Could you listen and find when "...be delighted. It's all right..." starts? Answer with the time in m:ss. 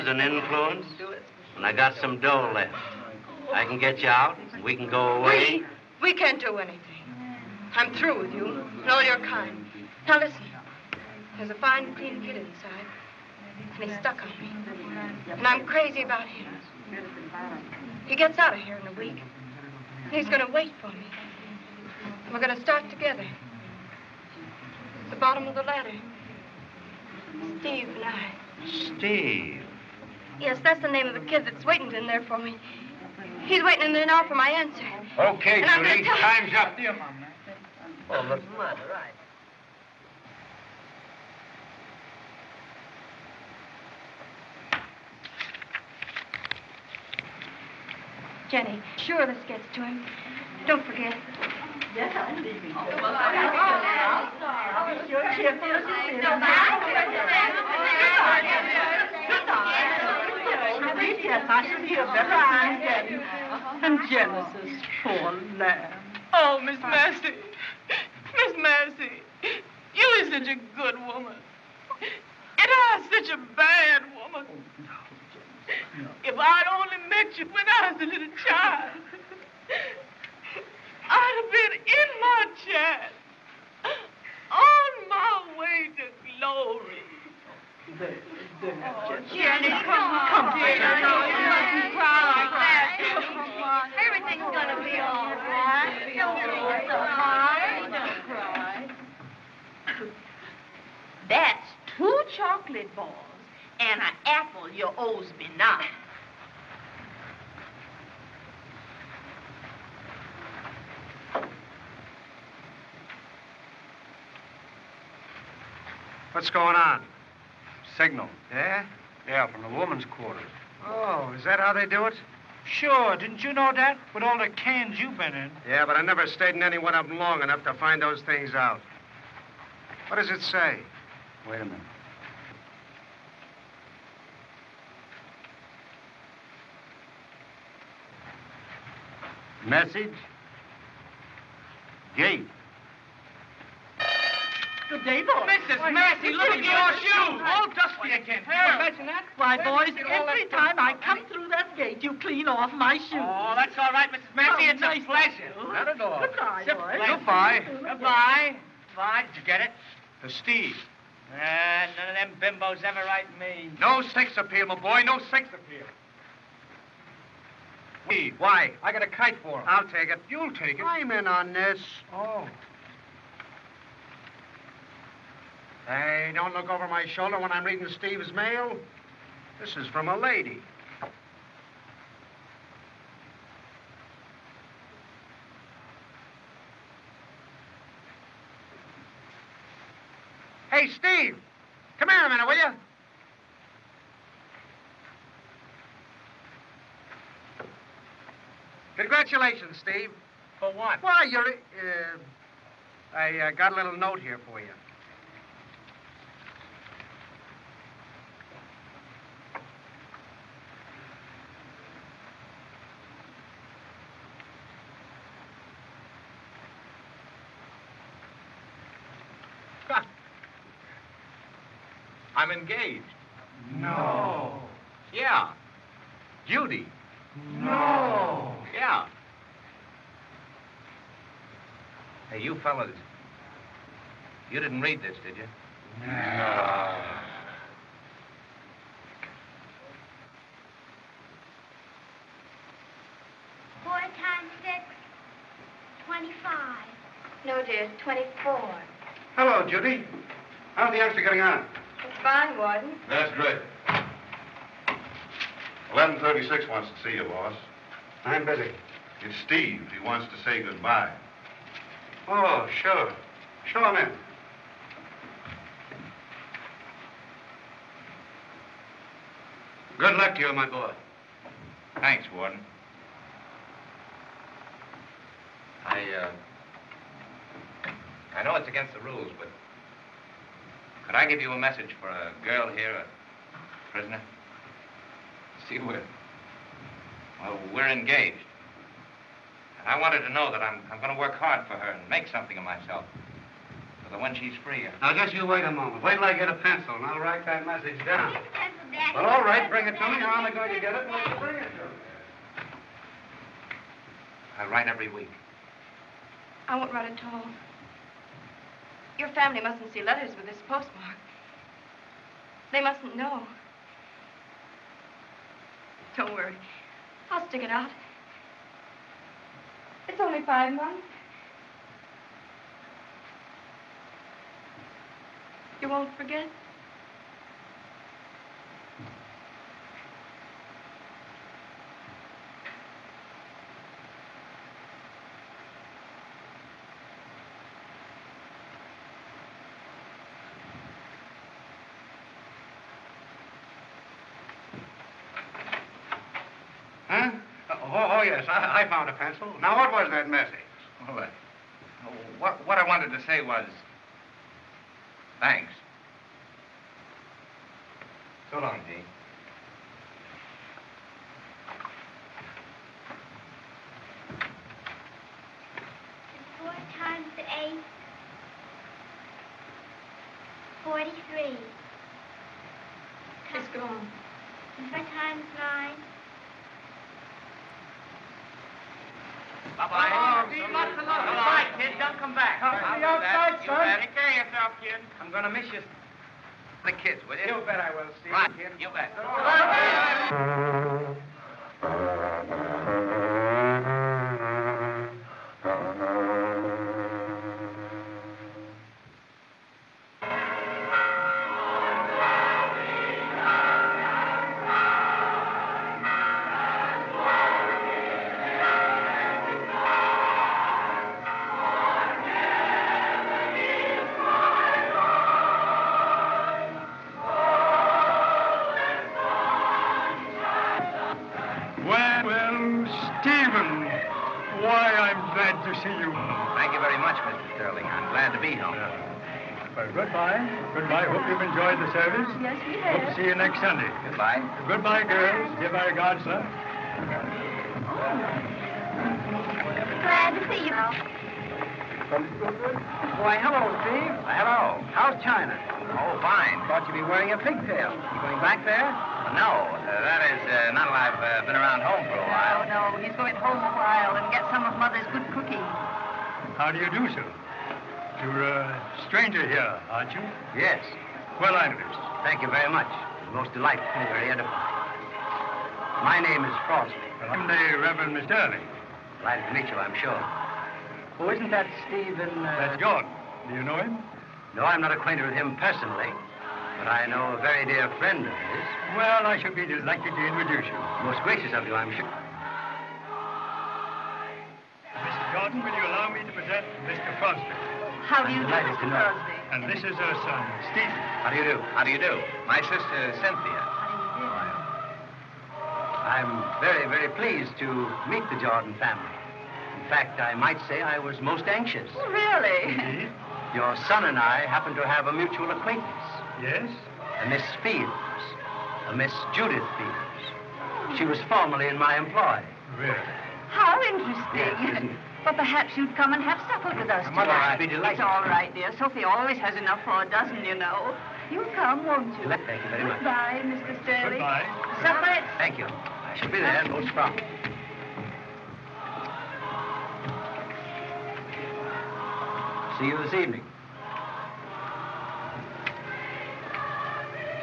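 8:37.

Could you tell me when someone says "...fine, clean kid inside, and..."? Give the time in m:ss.
0:11.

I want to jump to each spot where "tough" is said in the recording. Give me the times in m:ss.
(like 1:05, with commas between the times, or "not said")
not said.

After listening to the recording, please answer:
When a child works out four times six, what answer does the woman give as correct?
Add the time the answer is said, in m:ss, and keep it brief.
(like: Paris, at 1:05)
24, at 4:08.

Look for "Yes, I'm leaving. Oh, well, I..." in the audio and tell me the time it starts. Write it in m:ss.
0:51.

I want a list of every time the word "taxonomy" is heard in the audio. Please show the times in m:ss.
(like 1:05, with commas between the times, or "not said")
not said.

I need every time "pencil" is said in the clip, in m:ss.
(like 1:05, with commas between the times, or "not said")
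4:56, 5:49.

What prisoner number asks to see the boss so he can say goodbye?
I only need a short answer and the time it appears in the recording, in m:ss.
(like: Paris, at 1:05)
1136, at 4:15.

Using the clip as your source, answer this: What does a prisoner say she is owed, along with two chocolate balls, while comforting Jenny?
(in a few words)
an apple.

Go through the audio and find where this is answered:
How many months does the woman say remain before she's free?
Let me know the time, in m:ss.
5:20.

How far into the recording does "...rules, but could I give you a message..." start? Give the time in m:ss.
4:38.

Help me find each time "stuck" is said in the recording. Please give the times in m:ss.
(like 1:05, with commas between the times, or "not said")
0:13.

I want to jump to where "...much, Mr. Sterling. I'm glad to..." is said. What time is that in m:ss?
7:07.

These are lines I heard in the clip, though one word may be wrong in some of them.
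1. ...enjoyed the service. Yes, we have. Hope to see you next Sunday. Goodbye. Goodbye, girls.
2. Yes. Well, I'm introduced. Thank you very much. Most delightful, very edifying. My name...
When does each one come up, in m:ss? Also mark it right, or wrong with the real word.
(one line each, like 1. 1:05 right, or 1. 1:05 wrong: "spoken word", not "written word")
1. 7:11 right
2. 7:40 right.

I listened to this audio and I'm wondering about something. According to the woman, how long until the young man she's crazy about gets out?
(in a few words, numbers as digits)
a week.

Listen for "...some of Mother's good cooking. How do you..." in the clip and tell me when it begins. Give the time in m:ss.
7:34.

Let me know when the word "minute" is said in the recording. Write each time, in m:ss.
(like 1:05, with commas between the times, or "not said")
2:11, 3:12.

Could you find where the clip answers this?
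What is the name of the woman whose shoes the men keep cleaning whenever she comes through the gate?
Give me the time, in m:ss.
2:34.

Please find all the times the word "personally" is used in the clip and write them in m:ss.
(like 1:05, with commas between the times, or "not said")
7:55.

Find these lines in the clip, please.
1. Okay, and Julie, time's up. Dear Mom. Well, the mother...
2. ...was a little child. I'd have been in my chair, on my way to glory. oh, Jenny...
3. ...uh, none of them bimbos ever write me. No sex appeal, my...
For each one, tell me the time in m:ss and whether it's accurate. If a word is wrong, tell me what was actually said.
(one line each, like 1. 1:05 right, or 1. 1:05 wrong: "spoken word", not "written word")
1. 0:35 right
2. 1:17 right
3. 2:41 right.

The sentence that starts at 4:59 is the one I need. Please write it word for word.
Well, all right, bring it to me.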